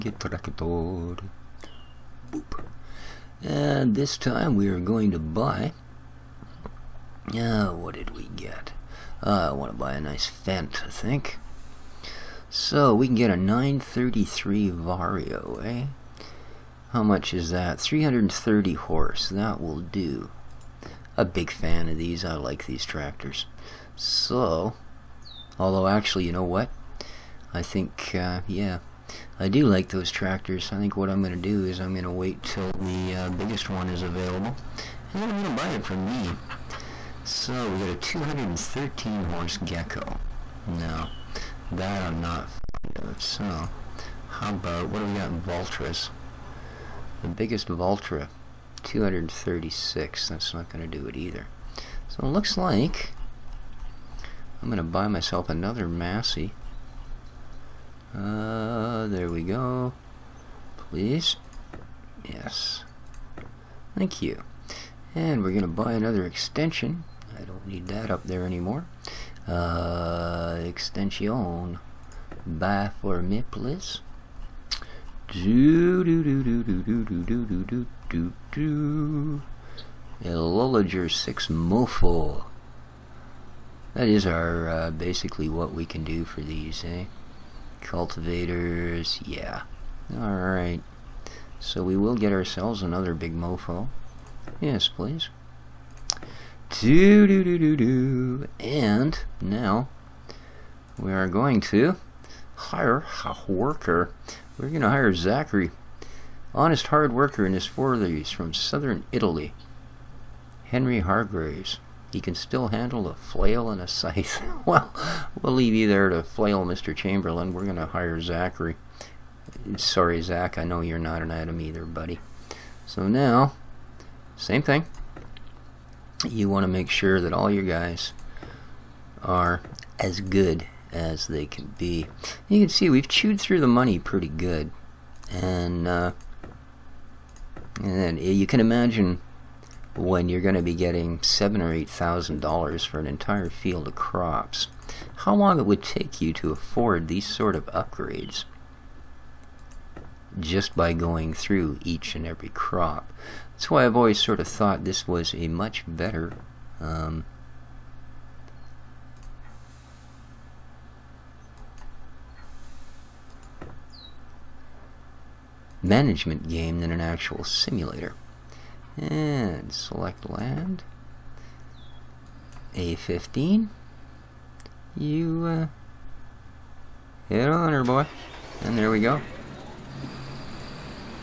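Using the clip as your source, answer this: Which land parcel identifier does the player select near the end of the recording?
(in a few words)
A15.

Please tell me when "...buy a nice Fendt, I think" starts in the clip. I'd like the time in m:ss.
0:09.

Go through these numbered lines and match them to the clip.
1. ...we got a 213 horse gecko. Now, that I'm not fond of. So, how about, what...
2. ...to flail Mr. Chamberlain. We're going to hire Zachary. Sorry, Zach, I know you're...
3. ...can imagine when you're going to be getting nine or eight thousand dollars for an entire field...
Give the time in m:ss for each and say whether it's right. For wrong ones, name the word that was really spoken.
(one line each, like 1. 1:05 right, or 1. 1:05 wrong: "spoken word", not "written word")
1. 0:37 right
2. 1:56 right
3. 2:18 wrong: "seven", not "nine".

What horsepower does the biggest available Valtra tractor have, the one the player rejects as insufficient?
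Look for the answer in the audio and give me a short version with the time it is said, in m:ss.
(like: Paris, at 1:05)
236, at 0:48.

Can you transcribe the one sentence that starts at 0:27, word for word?
I think, uh, yeah, I do like those tractors.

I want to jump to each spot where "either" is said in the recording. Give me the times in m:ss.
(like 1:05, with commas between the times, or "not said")
0:51, 2:01.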